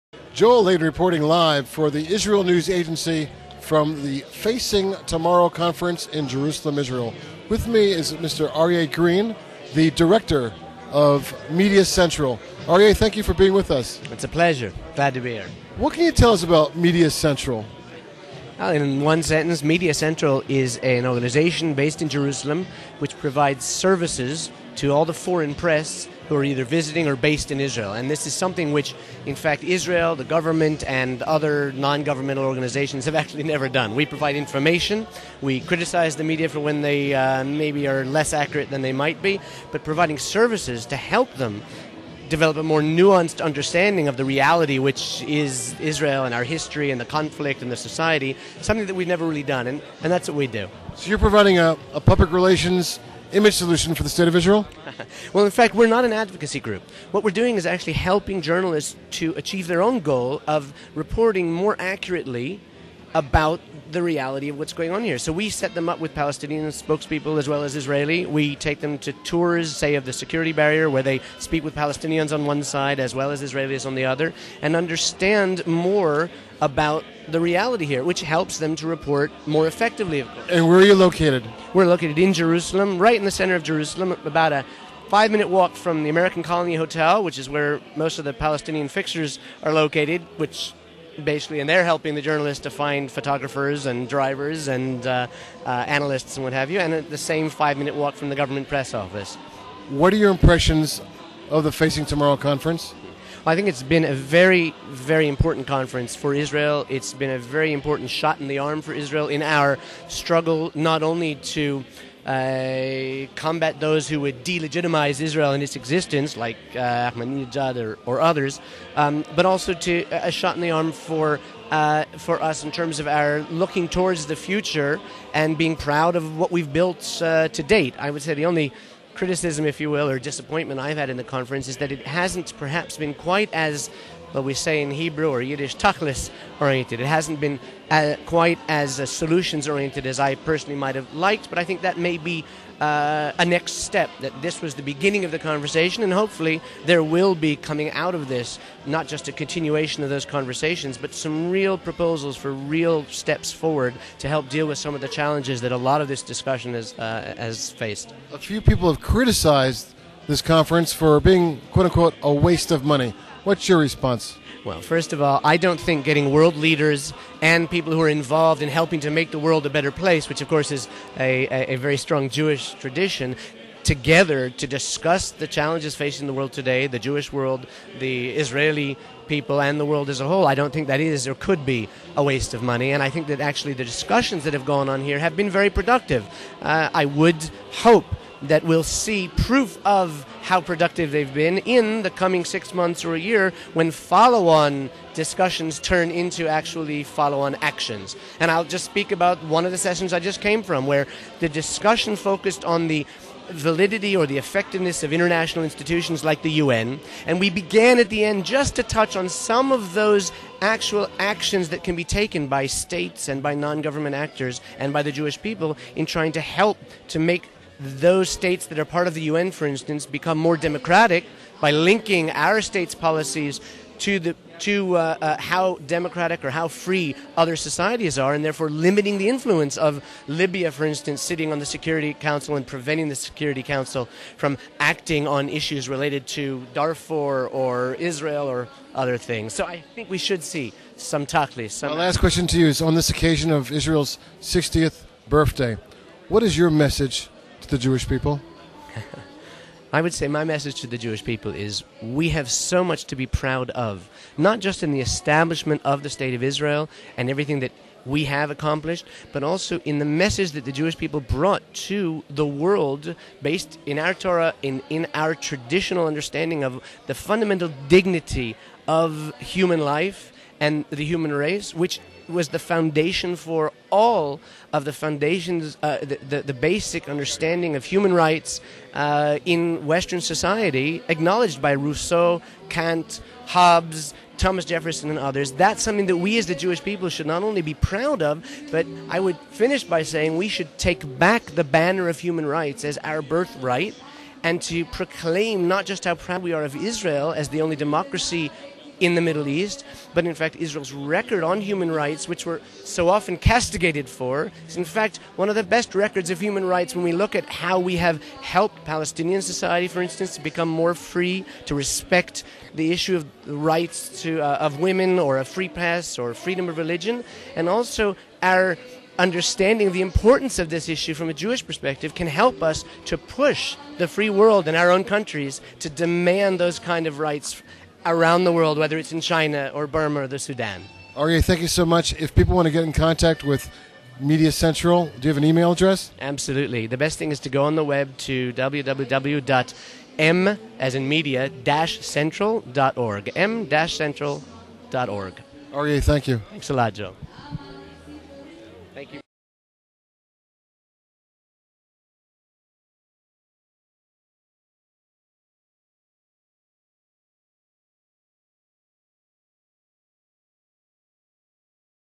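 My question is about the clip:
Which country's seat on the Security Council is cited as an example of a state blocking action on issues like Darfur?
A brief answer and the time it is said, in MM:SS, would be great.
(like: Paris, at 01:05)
Libya, at 03:50.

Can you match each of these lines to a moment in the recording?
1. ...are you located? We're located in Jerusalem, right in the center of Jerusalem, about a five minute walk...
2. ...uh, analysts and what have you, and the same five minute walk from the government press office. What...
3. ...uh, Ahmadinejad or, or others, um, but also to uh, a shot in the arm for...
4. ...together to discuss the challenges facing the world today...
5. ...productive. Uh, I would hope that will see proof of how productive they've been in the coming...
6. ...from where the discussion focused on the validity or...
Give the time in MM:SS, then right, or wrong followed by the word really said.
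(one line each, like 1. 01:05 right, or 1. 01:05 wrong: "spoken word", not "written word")
1. 01:20 right
2. 01:35 right
3. 01:56 right
4. 02:53 right
5. 03:05 right
6. 03:20 right.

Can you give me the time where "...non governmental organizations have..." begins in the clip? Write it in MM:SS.
00:31.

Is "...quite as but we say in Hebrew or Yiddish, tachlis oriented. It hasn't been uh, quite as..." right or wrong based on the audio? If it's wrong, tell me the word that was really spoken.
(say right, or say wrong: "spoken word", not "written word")
right.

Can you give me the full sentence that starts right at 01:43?
I think it's been a very, very important conference for Israel.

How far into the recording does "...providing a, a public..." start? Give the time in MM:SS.
00:51.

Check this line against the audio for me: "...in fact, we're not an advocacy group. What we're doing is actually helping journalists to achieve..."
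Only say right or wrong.
right.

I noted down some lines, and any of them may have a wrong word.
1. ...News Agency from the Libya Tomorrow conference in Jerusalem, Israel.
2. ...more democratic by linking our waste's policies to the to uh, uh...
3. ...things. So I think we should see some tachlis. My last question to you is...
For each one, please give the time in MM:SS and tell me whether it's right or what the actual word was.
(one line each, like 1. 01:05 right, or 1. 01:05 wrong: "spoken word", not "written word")
1. 00:02 wrong: "Facing", not "Libya"
2. 03:40 wrong: "state", not "waste"
3. 03:59 right.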